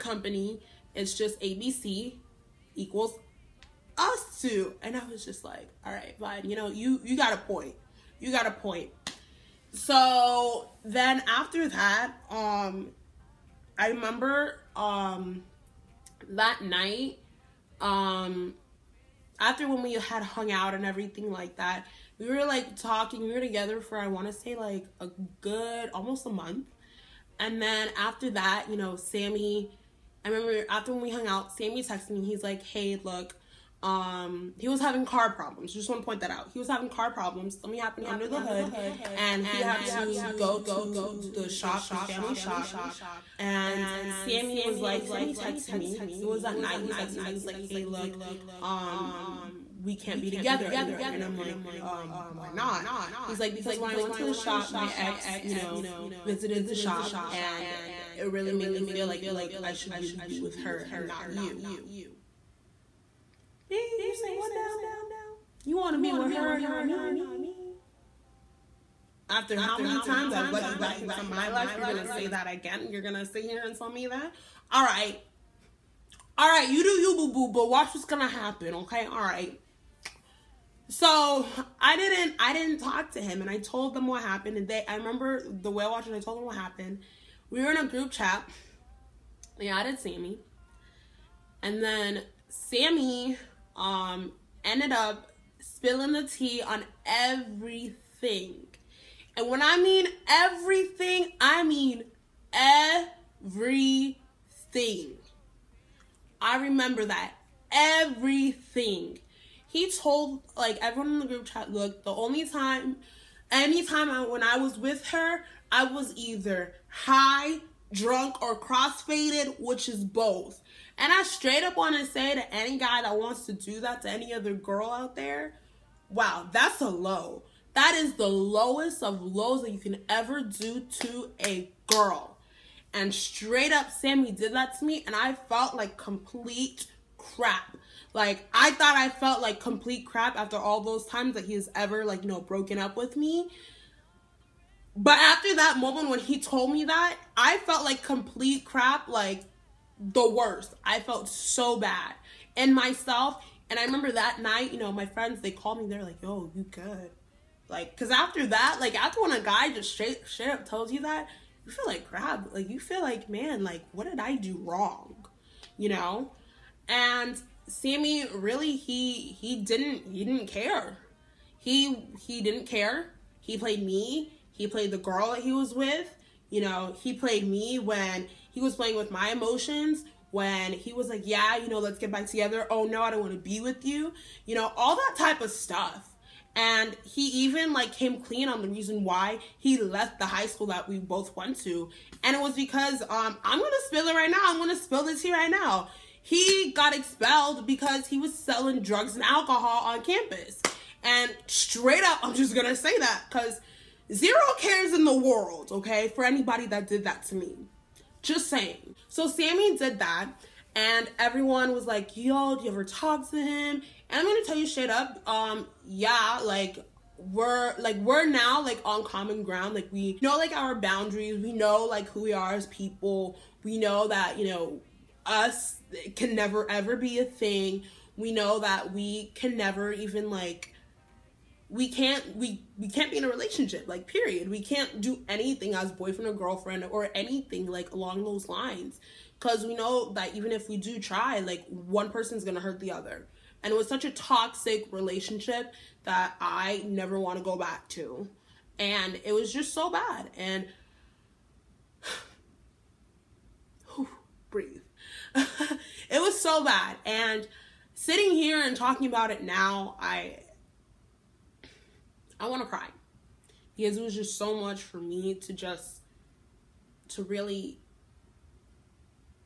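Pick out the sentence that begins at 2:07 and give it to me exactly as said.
That is the lowest of lows that you can ever do to a girl.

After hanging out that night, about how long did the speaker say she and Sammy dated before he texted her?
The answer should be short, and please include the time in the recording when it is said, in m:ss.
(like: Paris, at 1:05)
almost a month, at 0:25.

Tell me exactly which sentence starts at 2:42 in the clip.
Like you feel like, man, like what did I do wrong?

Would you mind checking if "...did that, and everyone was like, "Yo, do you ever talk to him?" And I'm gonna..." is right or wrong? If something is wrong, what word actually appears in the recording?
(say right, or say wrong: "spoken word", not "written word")
right.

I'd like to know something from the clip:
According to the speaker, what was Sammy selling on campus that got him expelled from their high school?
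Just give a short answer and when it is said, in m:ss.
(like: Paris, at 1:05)
drugs and alcohol, at 3:18.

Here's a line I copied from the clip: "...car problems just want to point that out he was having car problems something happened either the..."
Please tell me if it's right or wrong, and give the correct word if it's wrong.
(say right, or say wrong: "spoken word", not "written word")
wrong: "under", not "either".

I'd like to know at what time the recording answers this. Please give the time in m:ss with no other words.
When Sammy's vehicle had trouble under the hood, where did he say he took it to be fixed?
0:41.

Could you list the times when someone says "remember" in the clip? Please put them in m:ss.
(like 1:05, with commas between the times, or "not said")
0:13, 0:30, 1:24, 1:46, 2:33.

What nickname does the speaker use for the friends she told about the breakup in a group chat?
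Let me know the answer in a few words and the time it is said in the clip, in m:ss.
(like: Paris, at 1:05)
the whale watchers, at 1:25.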